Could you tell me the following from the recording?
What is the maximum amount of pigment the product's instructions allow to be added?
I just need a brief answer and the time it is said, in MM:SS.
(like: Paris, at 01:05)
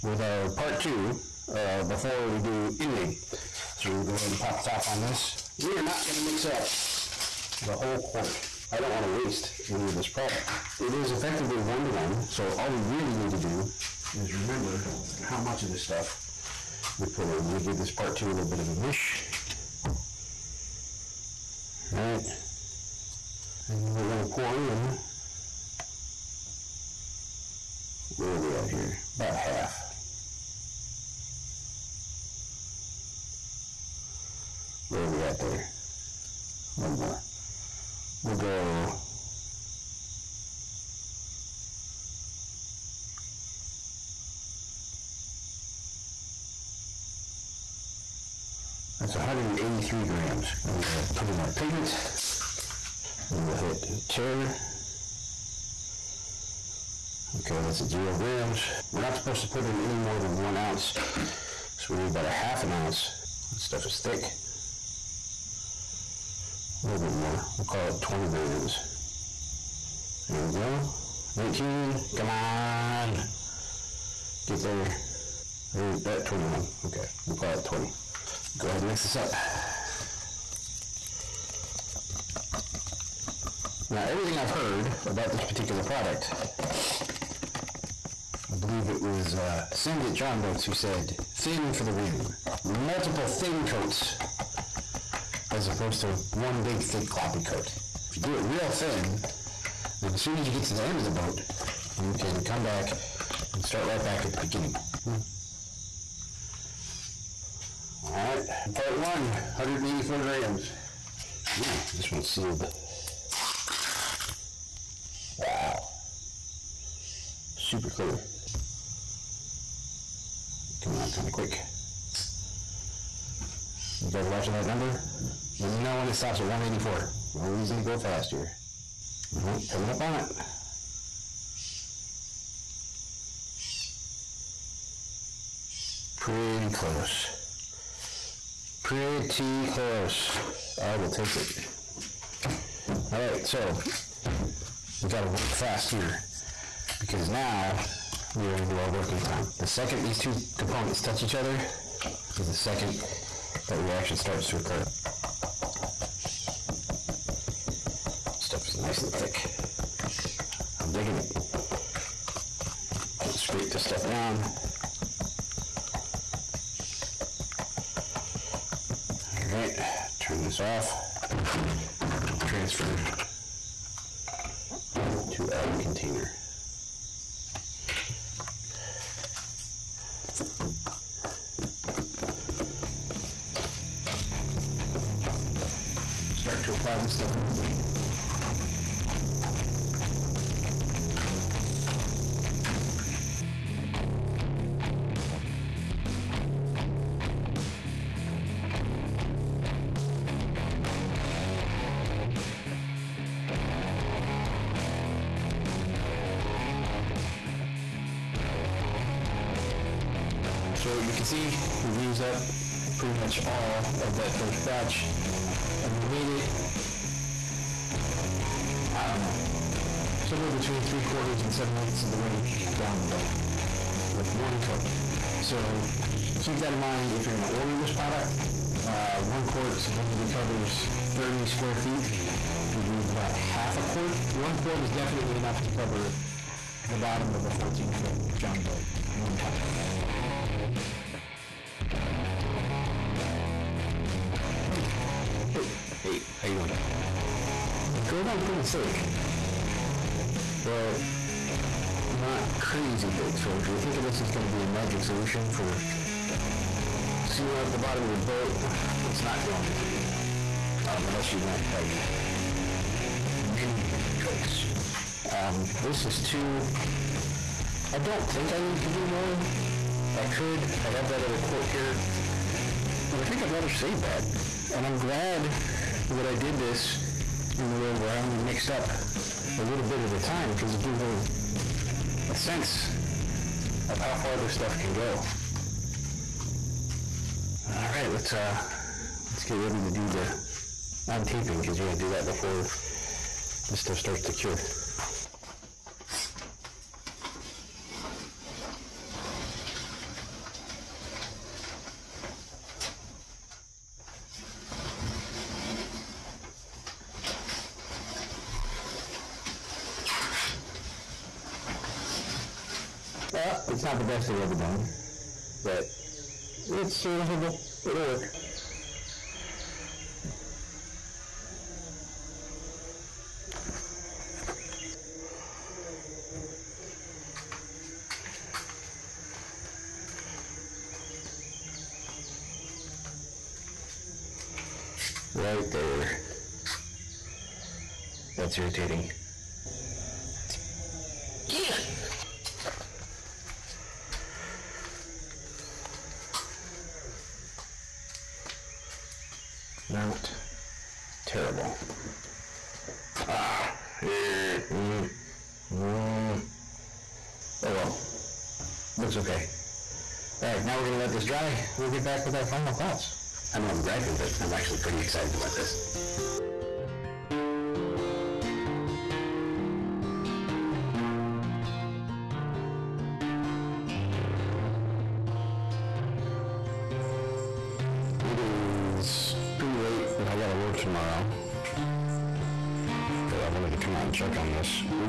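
one ounce, at 01:00.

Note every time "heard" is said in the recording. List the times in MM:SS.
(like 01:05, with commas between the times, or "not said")
01:24.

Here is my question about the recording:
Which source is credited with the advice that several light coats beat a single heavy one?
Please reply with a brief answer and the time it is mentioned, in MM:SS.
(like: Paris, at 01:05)
Send It John Boats, at 01:29.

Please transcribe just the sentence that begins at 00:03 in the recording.
So we're going to go ahead and pop the top on this.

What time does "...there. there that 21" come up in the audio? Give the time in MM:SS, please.
01:14.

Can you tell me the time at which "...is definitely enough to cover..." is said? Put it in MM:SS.
03:54.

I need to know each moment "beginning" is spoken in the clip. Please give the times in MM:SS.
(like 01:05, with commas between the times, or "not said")
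01:44.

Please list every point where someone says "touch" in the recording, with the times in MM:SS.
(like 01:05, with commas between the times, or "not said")
02:31.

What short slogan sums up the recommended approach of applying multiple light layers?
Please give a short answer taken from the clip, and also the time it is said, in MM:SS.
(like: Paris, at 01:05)
thin for the win, at 01:31.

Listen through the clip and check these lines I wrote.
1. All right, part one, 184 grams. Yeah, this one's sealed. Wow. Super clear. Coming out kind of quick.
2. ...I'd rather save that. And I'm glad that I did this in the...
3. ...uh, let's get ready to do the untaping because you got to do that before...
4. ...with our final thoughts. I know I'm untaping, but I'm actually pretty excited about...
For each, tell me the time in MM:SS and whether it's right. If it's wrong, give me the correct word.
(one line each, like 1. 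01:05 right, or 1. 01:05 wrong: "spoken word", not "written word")
1. 01:48 right
2. 04:33 right
3. 04:48 right
4. 06:02 wrong: "griping", not "untaping".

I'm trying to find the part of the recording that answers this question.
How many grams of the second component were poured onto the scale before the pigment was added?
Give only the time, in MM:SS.
00:49.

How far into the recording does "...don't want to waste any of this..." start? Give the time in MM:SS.
00:08.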